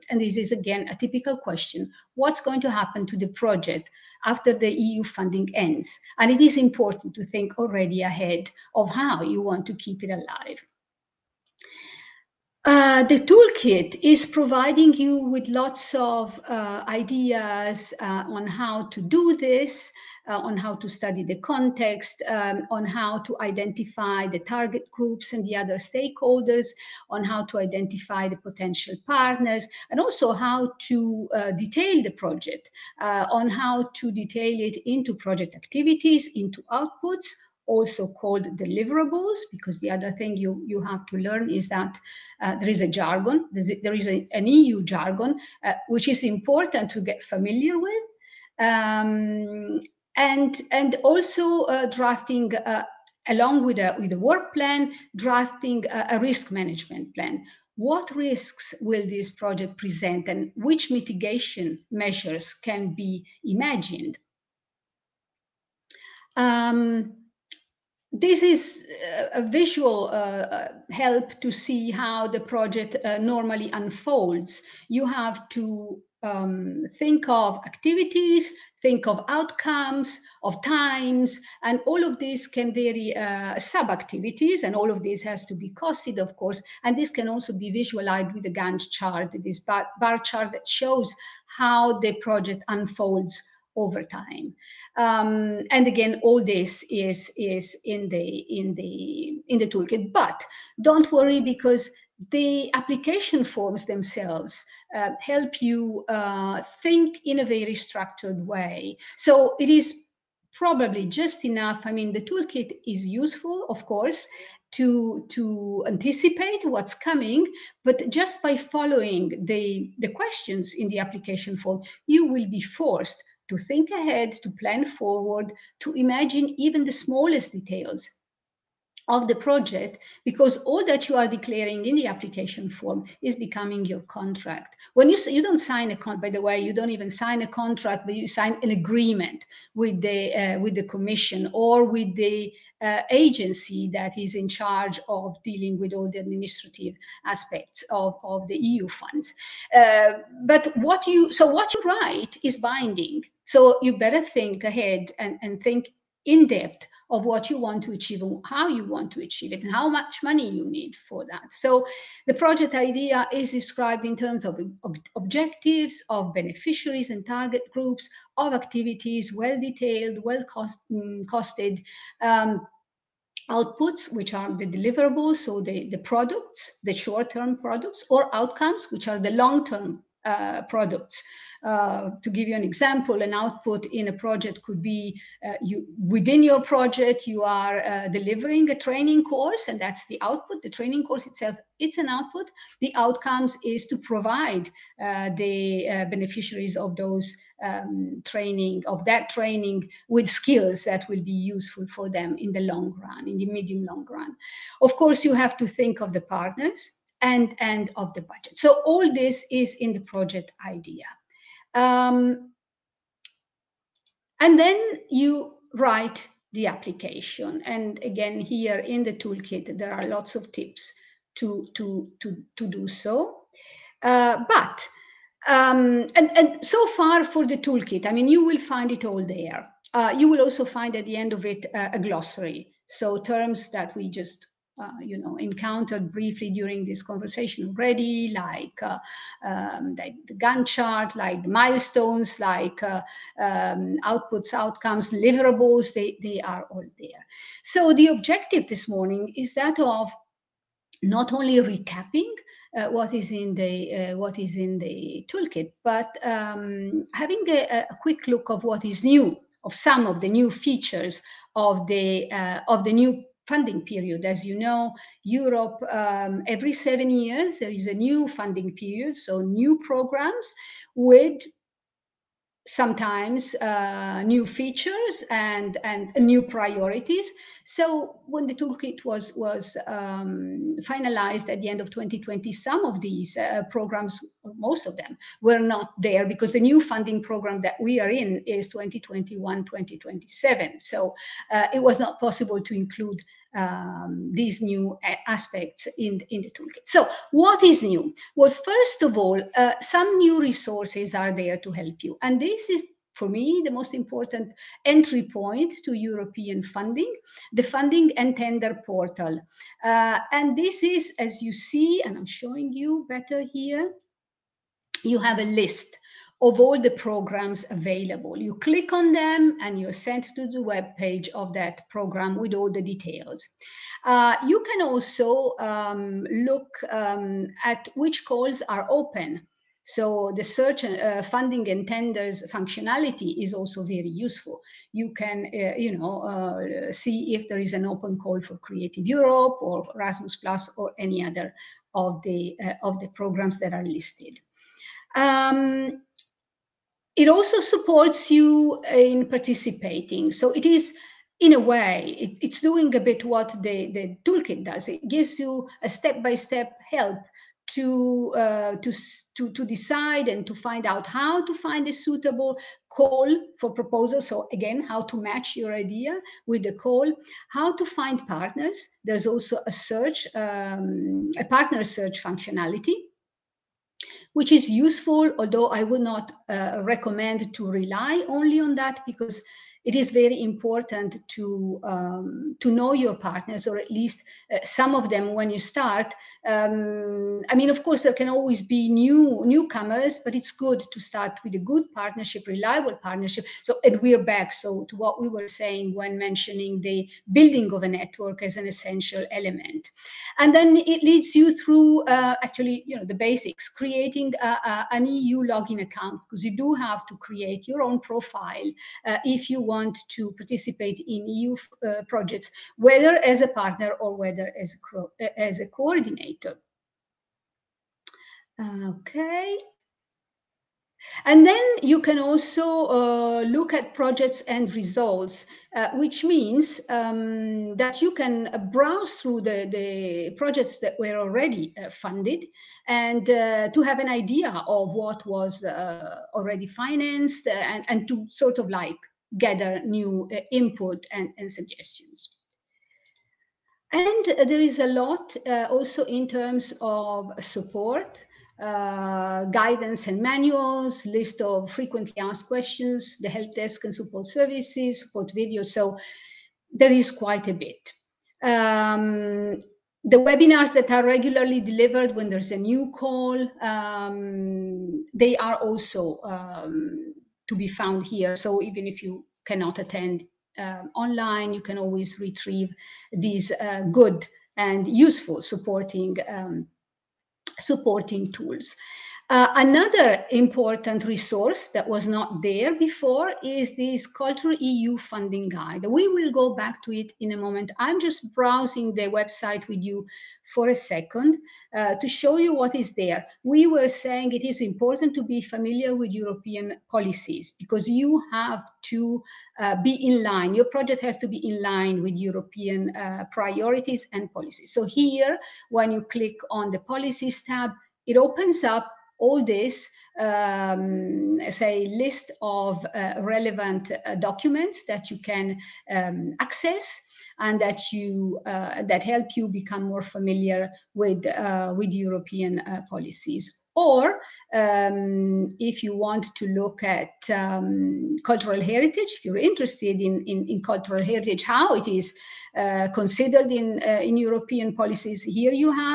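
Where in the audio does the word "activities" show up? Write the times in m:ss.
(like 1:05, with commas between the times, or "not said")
0:35, 1:17, 1:23, 2:48.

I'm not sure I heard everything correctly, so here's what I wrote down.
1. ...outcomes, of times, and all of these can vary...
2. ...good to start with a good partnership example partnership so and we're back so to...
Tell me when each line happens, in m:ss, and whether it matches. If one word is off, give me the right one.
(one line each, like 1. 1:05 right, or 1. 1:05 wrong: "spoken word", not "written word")
1. 1:19 right
2. 6:30 wrong: "reliable", not "example".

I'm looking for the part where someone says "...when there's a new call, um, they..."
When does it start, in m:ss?
7:42.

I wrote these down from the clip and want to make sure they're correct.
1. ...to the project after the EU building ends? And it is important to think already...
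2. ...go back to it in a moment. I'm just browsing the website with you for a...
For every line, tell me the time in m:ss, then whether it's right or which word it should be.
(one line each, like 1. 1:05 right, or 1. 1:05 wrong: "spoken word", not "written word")
1. 0:03 wrong: "funding", not "building"
2. 8:06 right.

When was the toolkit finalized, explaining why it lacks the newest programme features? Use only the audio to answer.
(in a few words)
end of 2020.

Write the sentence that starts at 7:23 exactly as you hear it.
And there is a lot uh, also in terms of support.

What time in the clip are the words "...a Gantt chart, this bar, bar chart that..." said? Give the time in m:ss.
1:28.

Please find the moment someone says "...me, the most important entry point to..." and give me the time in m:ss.
5:03.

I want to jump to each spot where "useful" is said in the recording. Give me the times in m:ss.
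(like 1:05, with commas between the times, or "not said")
1:53, 3:21, 5:34, 6:14, 7:54.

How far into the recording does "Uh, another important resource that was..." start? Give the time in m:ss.
7:59.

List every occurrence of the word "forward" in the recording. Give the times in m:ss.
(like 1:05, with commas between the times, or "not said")
2:04.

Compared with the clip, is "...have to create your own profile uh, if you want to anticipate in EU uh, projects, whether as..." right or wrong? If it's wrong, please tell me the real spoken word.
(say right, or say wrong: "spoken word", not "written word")
wrong: "participate", not "anticipate".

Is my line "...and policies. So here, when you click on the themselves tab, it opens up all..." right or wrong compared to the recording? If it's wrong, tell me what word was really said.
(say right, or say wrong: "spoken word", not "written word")
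wrong: "policies", not "themselves".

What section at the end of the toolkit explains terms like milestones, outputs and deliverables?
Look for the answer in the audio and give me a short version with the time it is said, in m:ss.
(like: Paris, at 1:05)
a glossary, at 3:51.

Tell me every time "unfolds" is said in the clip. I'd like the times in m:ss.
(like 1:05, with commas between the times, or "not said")
1:13, 1:32.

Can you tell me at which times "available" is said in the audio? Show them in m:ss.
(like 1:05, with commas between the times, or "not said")
5:17.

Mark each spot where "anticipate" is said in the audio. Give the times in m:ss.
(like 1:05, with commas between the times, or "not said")
1:55.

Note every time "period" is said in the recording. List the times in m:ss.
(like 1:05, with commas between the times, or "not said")
4:23, 4:28.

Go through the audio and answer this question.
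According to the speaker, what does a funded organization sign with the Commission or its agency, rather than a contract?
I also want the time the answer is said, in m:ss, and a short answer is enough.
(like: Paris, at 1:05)
an agreement, at 2:18.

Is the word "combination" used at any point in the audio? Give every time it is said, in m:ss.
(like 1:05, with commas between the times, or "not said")
not said.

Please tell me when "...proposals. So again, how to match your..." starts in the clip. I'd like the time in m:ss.
6:03.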